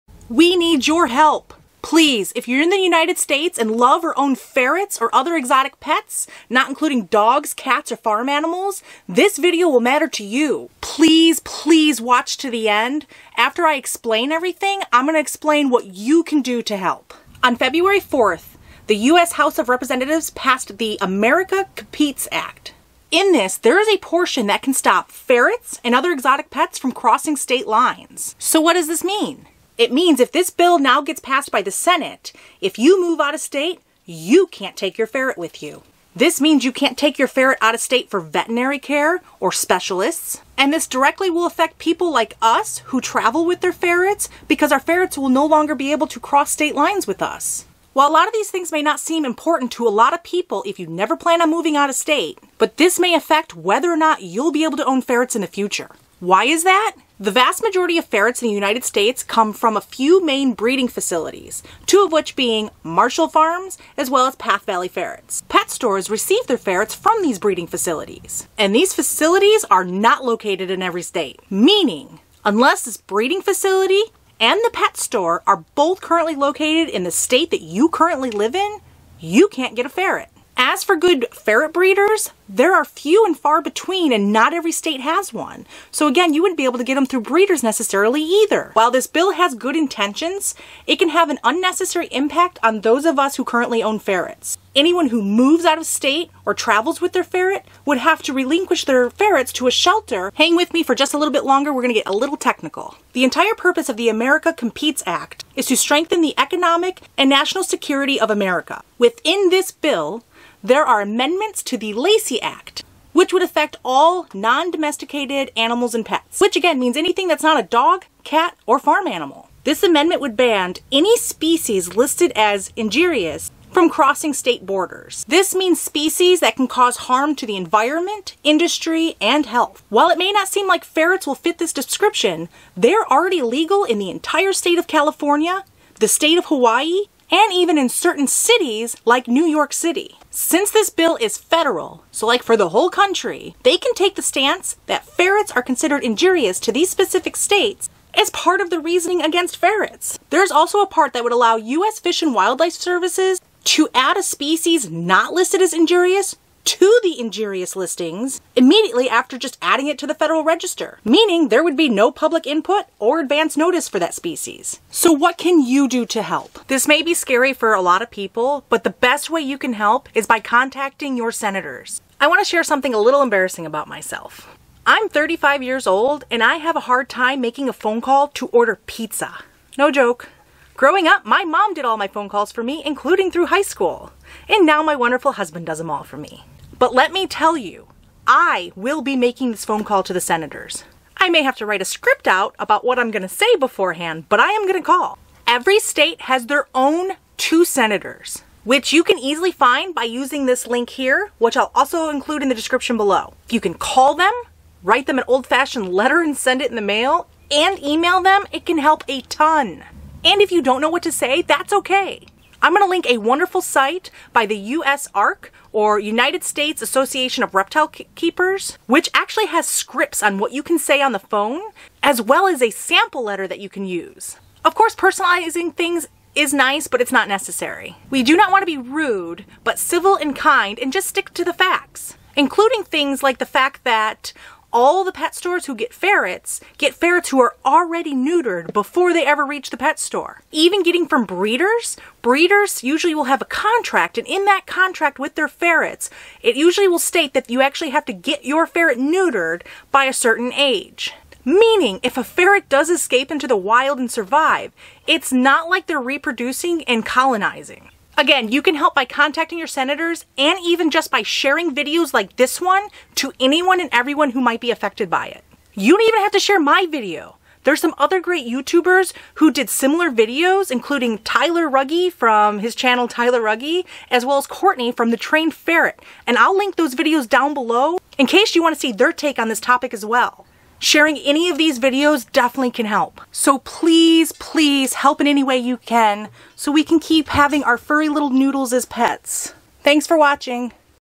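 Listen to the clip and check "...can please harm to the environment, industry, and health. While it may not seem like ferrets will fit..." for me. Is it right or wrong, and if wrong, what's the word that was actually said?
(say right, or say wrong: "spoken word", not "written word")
wrong: "cause", not "please".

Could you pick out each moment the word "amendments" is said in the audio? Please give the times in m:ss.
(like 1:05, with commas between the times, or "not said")
1:51, 1:59.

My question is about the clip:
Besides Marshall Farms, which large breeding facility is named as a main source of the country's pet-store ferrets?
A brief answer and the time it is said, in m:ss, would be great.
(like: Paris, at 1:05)
Path Valley Ferrets, at 1:04.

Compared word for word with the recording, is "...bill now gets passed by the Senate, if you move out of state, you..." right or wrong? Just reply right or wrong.
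right.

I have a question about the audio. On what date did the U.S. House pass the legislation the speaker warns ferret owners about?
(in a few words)
February 4th.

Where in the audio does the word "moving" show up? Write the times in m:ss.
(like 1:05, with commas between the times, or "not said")
0:51.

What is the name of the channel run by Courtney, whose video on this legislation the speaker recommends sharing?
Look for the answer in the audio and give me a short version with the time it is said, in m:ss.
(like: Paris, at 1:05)
The Trained Ferret, at 4:35.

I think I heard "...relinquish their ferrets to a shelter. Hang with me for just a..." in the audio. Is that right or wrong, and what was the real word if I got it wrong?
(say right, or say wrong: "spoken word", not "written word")
right.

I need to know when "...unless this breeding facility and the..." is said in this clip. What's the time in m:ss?
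1:12.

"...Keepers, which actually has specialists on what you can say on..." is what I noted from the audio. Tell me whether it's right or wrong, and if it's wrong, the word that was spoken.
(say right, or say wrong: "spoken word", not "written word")
wrong: "scripts", not "specialists".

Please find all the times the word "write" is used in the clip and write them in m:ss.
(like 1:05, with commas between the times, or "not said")
3:11, 3:24.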